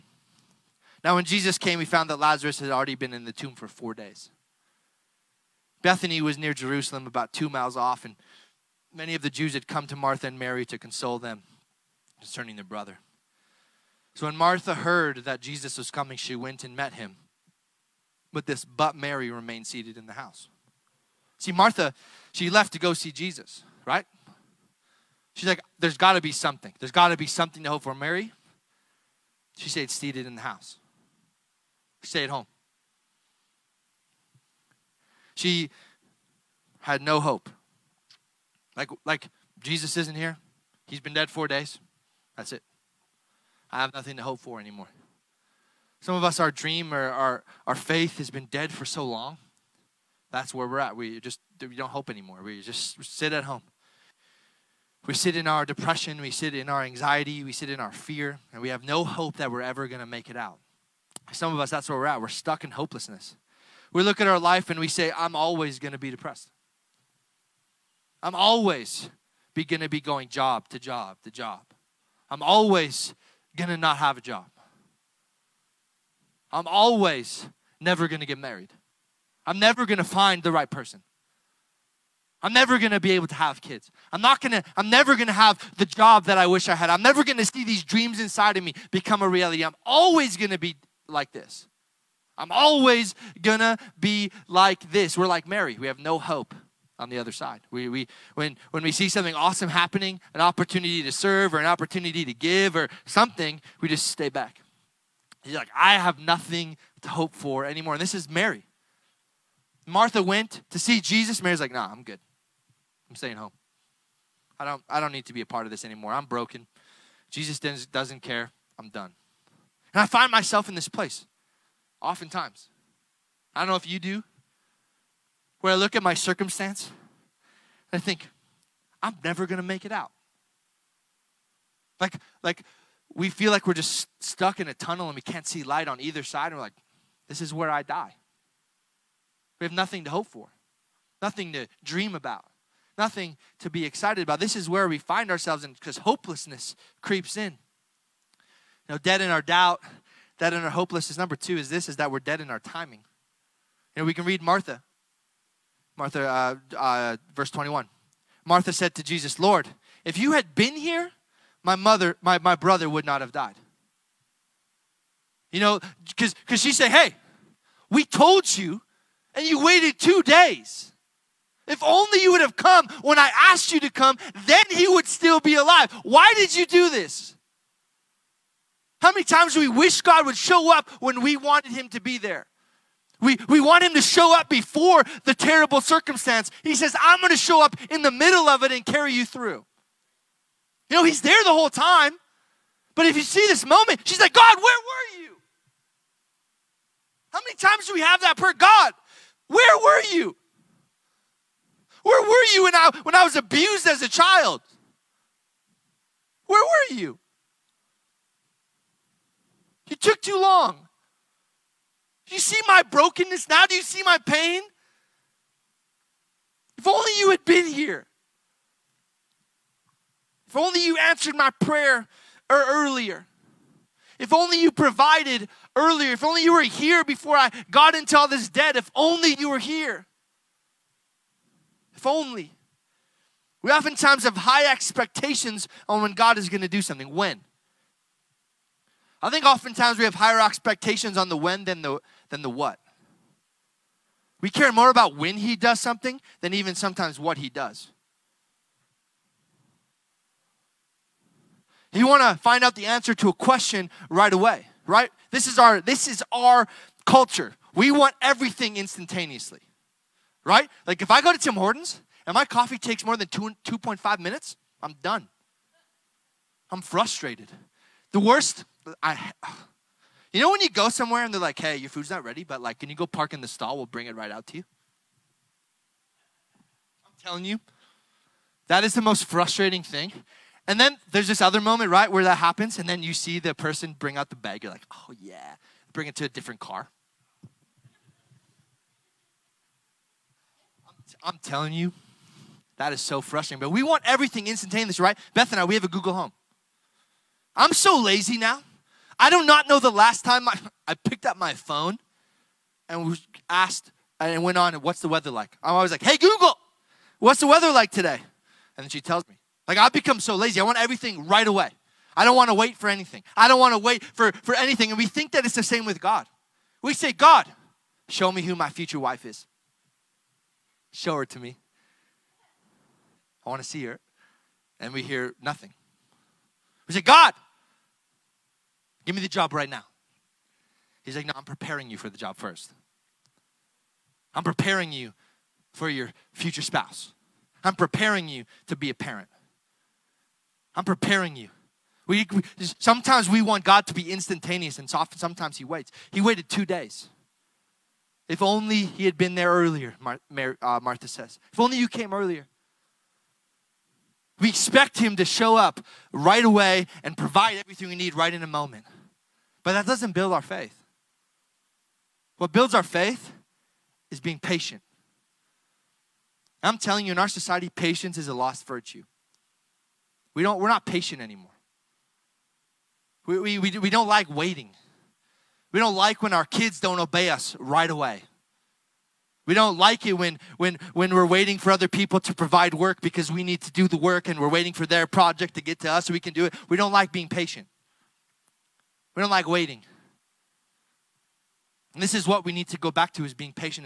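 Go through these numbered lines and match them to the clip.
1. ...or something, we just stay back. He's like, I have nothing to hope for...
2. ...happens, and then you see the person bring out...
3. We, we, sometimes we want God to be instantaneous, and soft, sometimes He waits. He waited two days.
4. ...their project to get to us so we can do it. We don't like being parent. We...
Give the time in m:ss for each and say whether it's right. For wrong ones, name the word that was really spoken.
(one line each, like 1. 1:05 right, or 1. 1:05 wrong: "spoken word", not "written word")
1. 1:42 right
2. 4:42 right
3. 5:42 right
4. 6:24 wrong: "patient", not "parent".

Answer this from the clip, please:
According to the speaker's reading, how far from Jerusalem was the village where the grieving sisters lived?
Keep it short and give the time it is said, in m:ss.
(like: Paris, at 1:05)
about 2 miles, at 0:07.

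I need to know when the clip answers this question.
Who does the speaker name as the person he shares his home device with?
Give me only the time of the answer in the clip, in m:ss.
4:55.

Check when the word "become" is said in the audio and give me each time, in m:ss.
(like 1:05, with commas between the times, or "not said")
1:28, 5:09.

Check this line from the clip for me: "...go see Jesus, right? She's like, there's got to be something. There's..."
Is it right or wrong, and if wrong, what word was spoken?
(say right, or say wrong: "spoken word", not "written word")
right.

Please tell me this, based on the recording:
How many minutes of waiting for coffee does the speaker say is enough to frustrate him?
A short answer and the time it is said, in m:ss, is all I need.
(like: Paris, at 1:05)
2.5 minutes, at 4:23.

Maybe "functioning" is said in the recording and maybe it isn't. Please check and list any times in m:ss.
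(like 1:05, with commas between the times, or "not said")
not said.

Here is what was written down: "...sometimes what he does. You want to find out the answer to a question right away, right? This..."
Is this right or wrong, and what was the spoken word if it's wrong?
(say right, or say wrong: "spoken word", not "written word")
right.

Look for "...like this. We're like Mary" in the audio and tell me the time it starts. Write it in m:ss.
1:34.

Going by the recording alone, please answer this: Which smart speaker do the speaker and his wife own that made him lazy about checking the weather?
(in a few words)
Google Home.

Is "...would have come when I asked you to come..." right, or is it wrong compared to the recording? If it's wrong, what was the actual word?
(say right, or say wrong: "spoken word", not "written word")
right.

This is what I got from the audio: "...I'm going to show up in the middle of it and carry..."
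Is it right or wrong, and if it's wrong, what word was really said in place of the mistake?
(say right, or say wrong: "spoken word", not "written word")
right.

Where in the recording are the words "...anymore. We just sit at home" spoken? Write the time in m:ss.
0:52.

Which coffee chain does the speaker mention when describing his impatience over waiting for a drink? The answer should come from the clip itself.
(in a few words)
Tim Hortons.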